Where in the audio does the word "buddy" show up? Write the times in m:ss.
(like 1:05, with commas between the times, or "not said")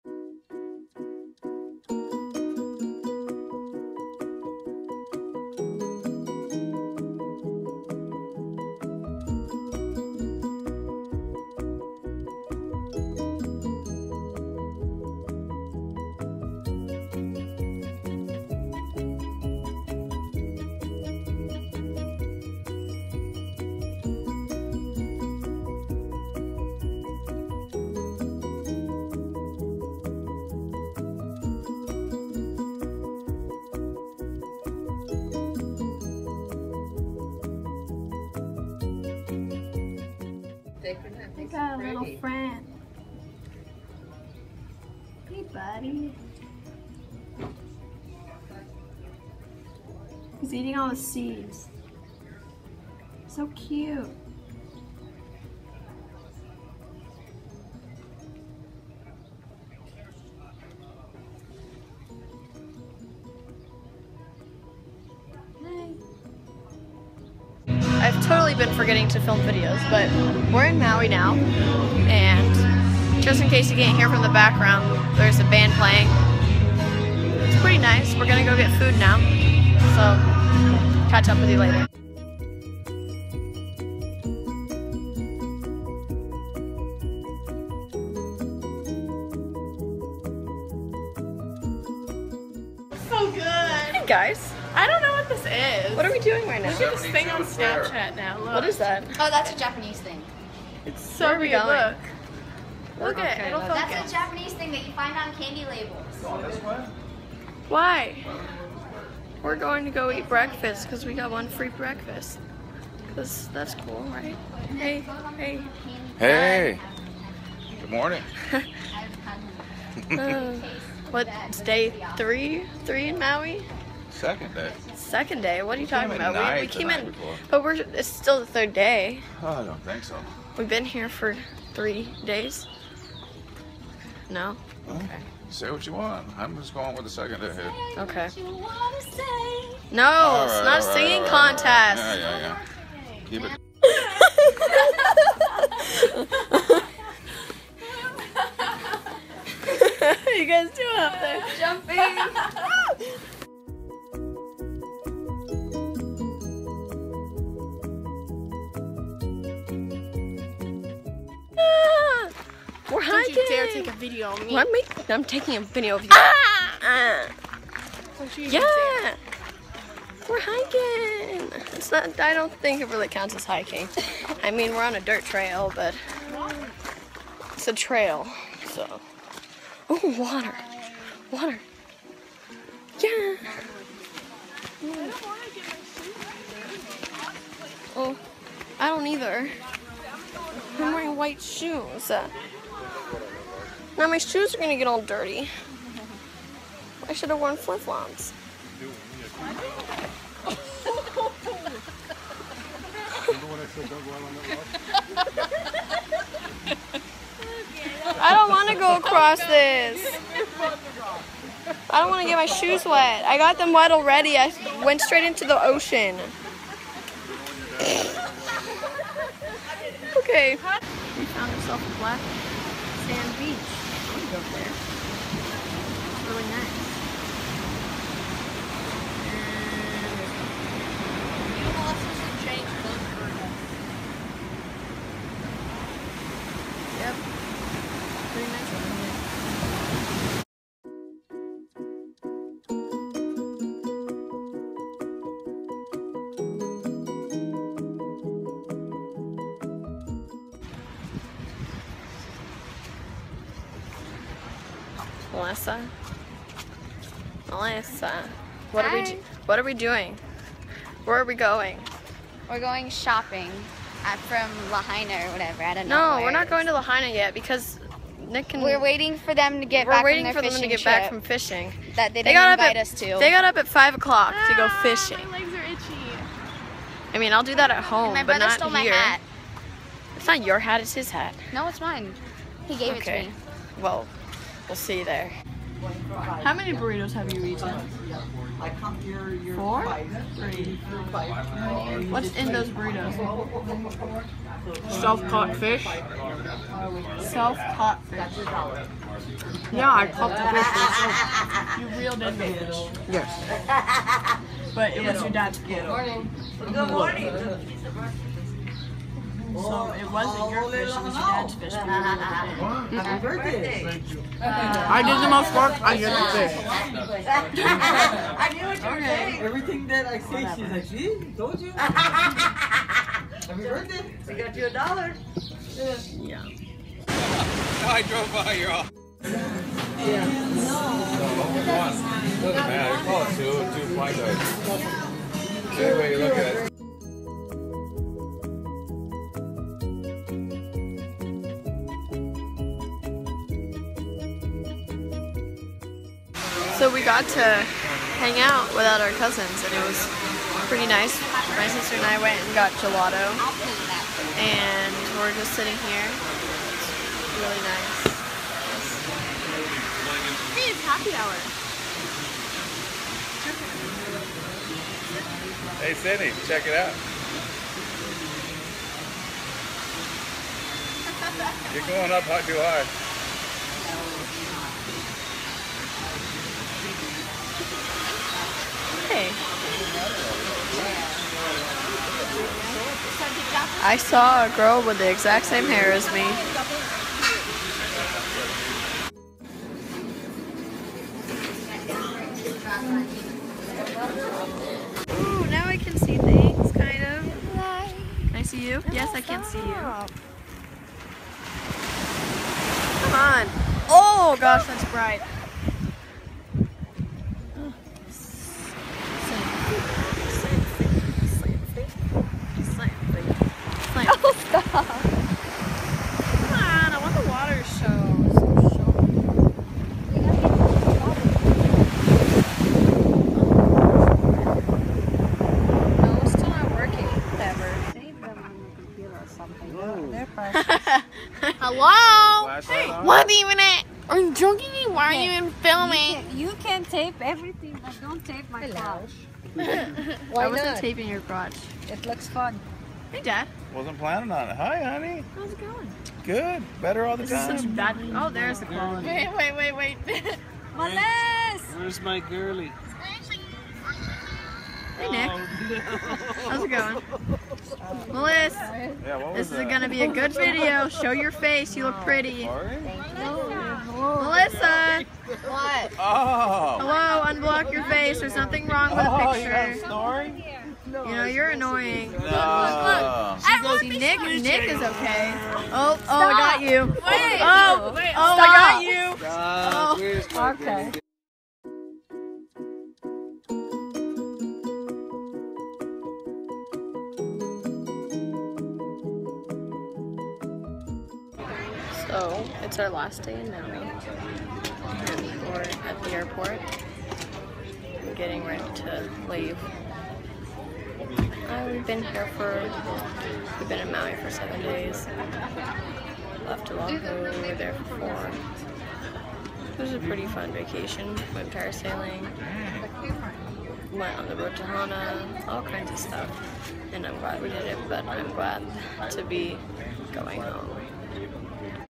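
not said.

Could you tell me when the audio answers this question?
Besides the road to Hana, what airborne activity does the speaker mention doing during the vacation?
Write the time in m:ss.
8:31.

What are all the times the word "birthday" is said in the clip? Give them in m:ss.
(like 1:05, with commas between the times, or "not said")
5:13, 5:23.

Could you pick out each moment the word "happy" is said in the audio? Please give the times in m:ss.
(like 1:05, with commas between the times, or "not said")
5:11, 5:21, 6:00.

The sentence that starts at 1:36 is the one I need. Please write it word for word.
Look at this thing on Snapchat now.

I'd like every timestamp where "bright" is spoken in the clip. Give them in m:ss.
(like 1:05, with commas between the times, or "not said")
6:44.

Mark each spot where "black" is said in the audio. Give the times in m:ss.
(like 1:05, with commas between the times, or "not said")
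3:41.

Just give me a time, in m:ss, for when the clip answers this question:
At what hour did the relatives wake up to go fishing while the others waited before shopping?
4:33.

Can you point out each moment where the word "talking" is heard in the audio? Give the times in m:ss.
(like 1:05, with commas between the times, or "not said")
2:05.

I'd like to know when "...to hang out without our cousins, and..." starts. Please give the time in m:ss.
5:47.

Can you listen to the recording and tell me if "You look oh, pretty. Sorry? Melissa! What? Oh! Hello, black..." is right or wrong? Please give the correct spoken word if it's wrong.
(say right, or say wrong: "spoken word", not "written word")
wrong: "unblock", not "black".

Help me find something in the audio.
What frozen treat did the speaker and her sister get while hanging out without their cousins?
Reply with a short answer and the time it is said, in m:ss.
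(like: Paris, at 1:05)
Gelato, at 5:52.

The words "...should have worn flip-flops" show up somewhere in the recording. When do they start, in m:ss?
3:17.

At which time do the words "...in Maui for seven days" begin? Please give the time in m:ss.
8:23.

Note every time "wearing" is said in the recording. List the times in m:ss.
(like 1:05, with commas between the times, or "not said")
3:10.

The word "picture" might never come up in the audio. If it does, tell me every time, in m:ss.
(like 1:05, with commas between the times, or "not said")
7:49.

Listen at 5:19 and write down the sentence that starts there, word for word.
Everything that I say, she's like, see, told you.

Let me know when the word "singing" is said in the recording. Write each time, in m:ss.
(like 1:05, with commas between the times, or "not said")
2:20.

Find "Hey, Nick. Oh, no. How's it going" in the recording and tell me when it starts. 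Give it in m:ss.
7:34.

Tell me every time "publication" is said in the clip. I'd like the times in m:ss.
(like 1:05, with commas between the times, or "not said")
not said.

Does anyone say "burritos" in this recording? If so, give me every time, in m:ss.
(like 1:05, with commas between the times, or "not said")
4:46, 4:52.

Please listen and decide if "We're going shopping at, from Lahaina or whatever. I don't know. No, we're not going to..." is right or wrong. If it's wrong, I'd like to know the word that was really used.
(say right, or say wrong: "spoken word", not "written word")
right.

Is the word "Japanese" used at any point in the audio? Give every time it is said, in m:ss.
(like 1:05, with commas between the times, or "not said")
1:39, 1:44.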